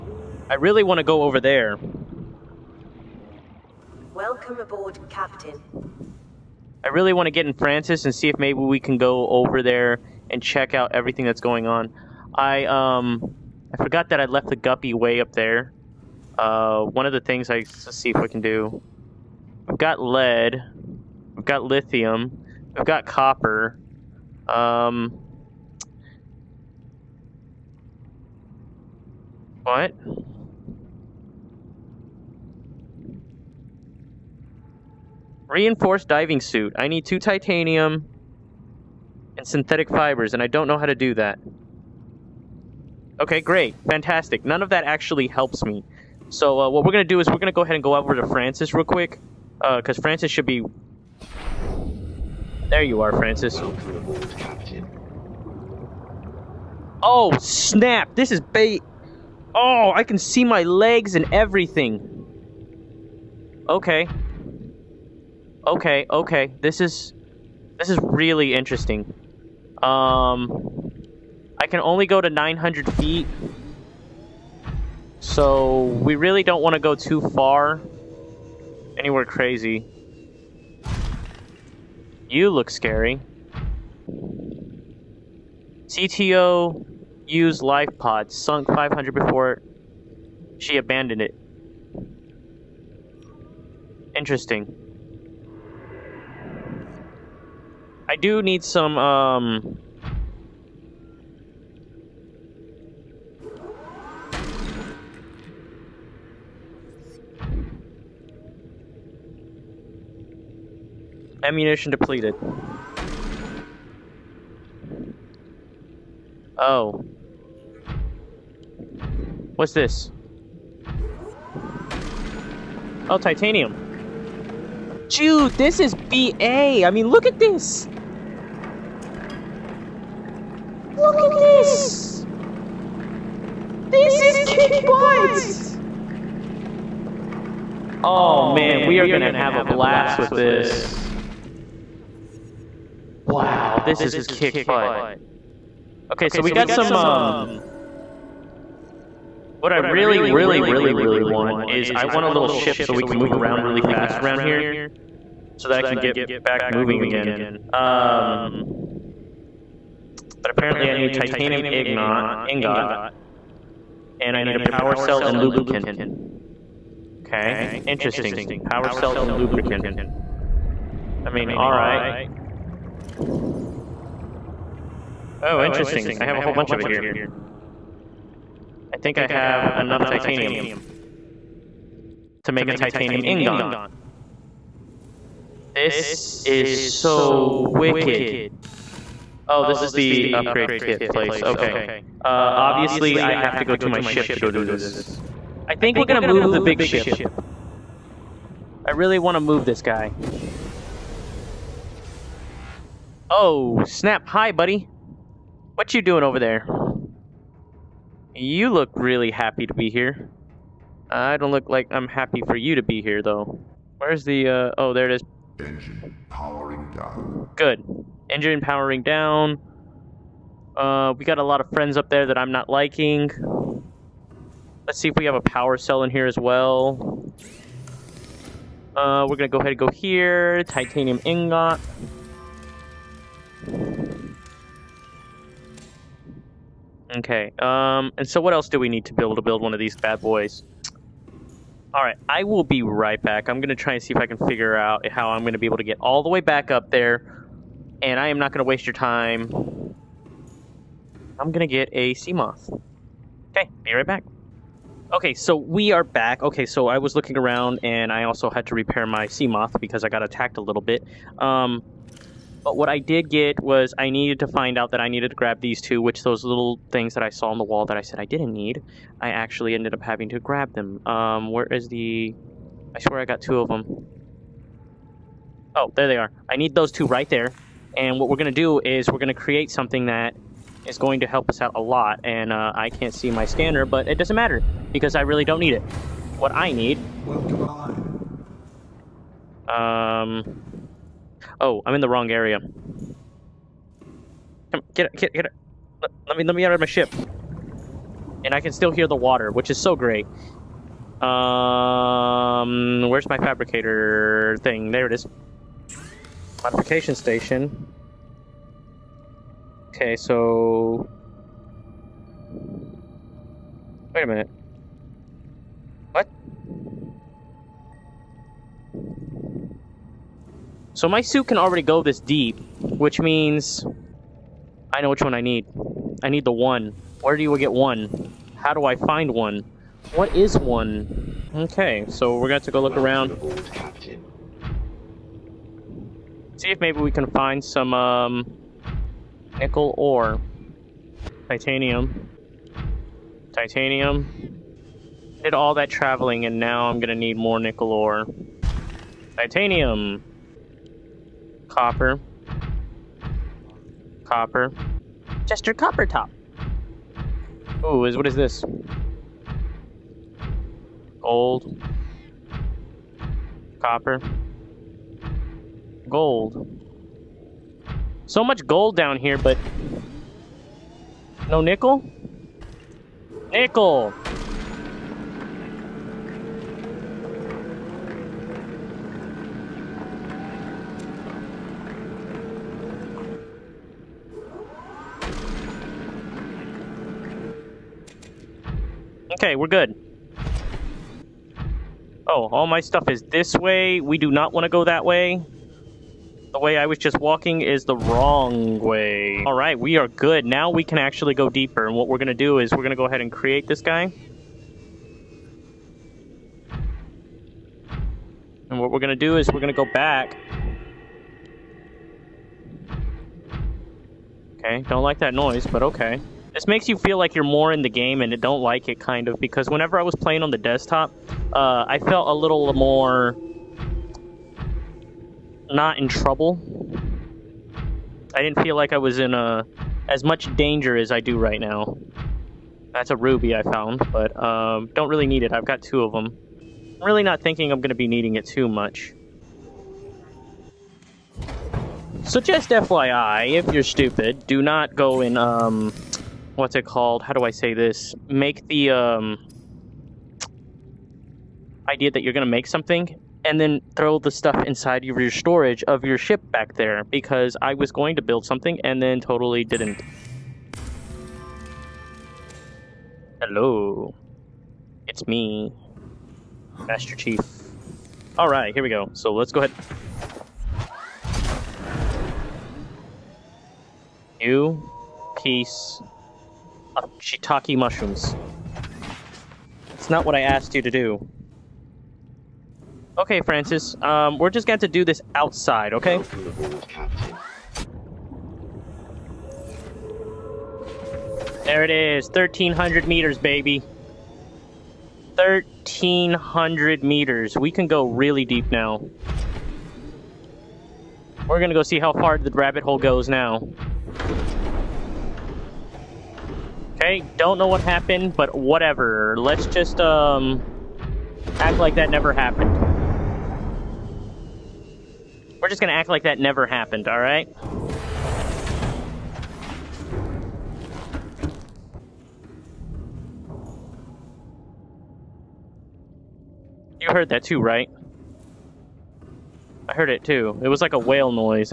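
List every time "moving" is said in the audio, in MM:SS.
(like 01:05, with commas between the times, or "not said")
02:36.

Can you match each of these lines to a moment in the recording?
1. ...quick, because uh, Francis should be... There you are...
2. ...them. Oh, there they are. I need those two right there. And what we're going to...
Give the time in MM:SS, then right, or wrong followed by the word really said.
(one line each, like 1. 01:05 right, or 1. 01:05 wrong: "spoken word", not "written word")
1. 00:48 right
2. 04:33 right.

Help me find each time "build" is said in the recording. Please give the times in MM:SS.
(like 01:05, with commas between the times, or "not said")
03:59, 07:38.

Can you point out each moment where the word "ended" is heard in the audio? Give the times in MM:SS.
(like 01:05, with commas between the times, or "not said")
04:29.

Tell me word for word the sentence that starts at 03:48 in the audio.
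Uh, we're gonna go ahead and go here.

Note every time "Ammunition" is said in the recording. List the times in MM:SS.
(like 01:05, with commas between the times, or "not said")
01:51.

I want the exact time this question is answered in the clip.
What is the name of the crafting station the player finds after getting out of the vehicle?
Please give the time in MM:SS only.
05:06.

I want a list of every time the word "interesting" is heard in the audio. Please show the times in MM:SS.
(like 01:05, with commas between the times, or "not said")
01:08, 01:34, 02:47, 02:55.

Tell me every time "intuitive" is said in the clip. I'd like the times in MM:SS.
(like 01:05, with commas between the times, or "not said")
not said.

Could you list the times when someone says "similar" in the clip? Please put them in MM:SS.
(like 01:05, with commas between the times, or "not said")
not said.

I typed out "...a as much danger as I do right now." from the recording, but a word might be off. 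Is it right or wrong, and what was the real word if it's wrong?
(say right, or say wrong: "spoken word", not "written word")
right.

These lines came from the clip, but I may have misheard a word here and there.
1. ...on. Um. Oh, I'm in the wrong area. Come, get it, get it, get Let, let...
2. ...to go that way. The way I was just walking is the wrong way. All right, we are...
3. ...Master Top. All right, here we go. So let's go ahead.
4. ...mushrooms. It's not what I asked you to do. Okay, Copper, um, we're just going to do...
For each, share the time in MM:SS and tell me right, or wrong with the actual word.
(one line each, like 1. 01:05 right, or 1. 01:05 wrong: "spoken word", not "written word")
1. 04:47 right
2. 06:34 right
3. 07:46 wrong: "Chief", not "Top"
4. 07:57 wrong: "Francis", not "Copper".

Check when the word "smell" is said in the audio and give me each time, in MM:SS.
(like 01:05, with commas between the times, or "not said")
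not said.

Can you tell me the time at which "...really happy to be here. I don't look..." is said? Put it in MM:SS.
03:28.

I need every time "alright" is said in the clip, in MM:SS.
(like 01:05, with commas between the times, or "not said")
02:51, 04:01, 08:37.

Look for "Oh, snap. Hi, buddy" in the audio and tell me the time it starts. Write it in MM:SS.
03:23.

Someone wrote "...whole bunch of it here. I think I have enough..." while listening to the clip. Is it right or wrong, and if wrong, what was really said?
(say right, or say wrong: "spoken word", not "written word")
right.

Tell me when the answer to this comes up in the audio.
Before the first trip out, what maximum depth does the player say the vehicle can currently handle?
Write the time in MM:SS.
01:12.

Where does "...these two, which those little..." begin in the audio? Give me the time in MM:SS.
04:25.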